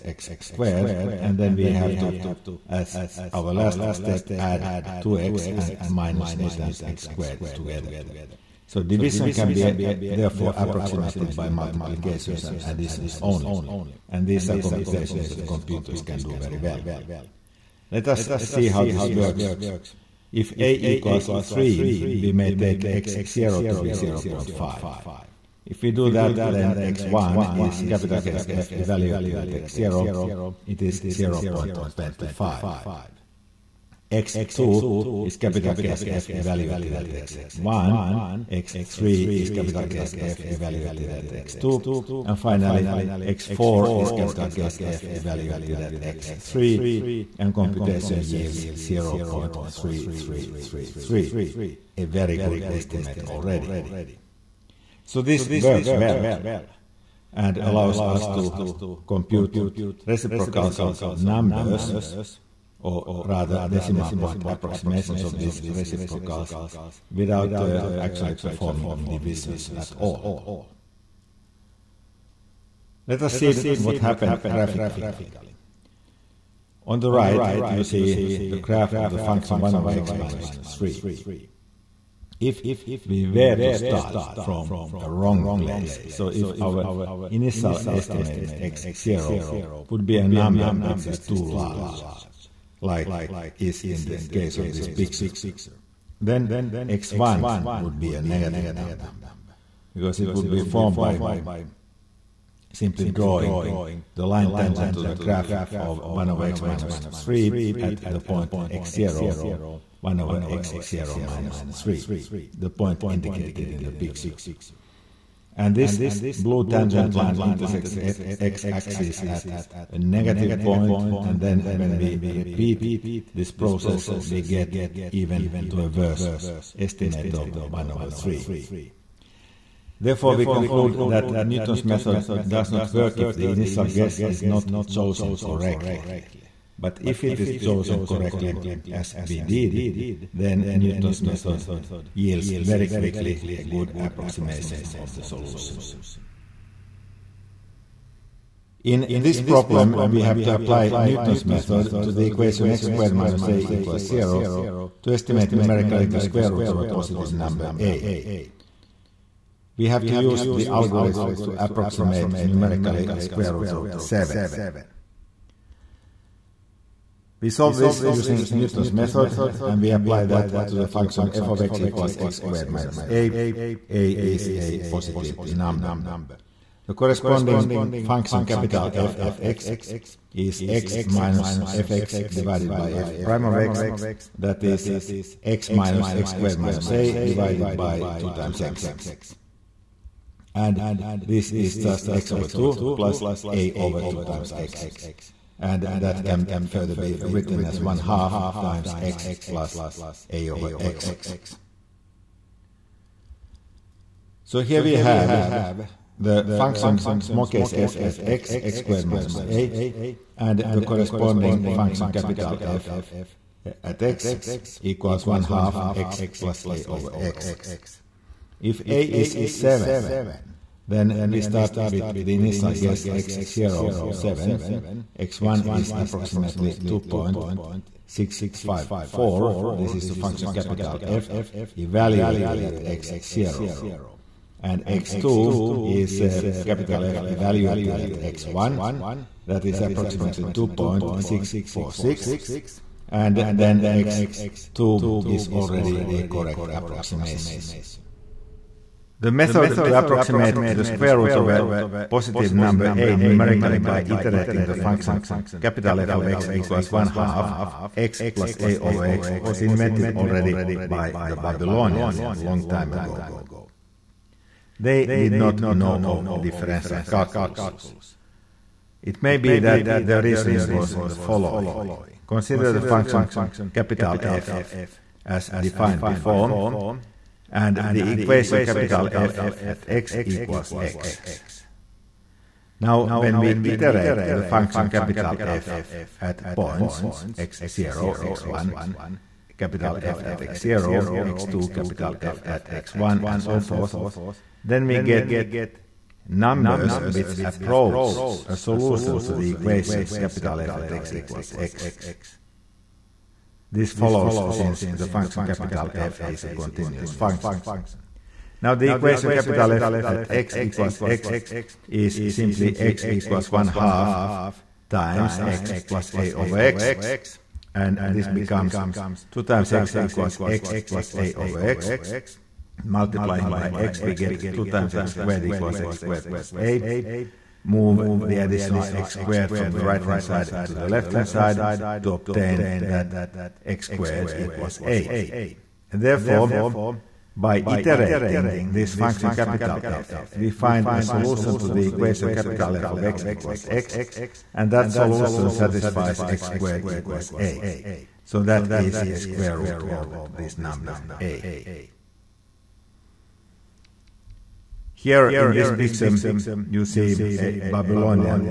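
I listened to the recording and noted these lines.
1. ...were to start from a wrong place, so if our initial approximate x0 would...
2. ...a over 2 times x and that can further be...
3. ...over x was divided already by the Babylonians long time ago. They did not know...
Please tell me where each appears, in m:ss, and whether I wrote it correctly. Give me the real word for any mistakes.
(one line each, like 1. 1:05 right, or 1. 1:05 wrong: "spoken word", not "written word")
1. 1:23 wrong: "estimate", not "approximate"
2. 3:13 right
3. 4:18 wrong: "invented", not "divided".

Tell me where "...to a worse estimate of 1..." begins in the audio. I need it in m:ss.
2:05.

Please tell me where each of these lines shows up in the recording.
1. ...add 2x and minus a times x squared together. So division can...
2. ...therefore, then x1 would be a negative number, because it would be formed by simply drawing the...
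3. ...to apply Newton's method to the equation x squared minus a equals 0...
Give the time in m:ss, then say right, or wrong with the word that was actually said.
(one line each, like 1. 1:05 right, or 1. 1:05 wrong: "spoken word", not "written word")
1. 0:04 right
2. 1:34 wrong: "picture", not "therefore"
3. 2:30 right.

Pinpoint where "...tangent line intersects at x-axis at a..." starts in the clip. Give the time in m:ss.
1:56.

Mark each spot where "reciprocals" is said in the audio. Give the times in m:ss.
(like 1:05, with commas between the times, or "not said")
1:00, 1:05.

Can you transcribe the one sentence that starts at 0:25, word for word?
If we do that, then x1 is capital case F evaluated at x0, it is 0.25.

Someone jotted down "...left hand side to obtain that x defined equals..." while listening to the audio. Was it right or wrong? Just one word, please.
wrong.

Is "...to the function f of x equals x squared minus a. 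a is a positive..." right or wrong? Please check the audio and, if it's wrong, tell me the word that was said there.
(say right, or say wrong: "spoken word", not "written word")
right.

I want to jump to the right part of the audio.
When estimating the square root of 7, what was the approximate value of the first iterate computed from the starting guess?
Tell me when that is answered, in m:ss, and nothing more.
3:46.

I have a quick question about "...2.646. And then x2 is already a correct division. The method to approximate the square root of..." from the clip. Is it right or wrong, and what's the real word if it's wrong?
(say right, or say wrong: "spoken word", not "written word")
wrong: "approximation", not "division".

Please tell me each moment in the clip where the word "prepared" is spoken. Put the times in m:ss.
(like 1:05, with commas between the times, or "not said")
not said.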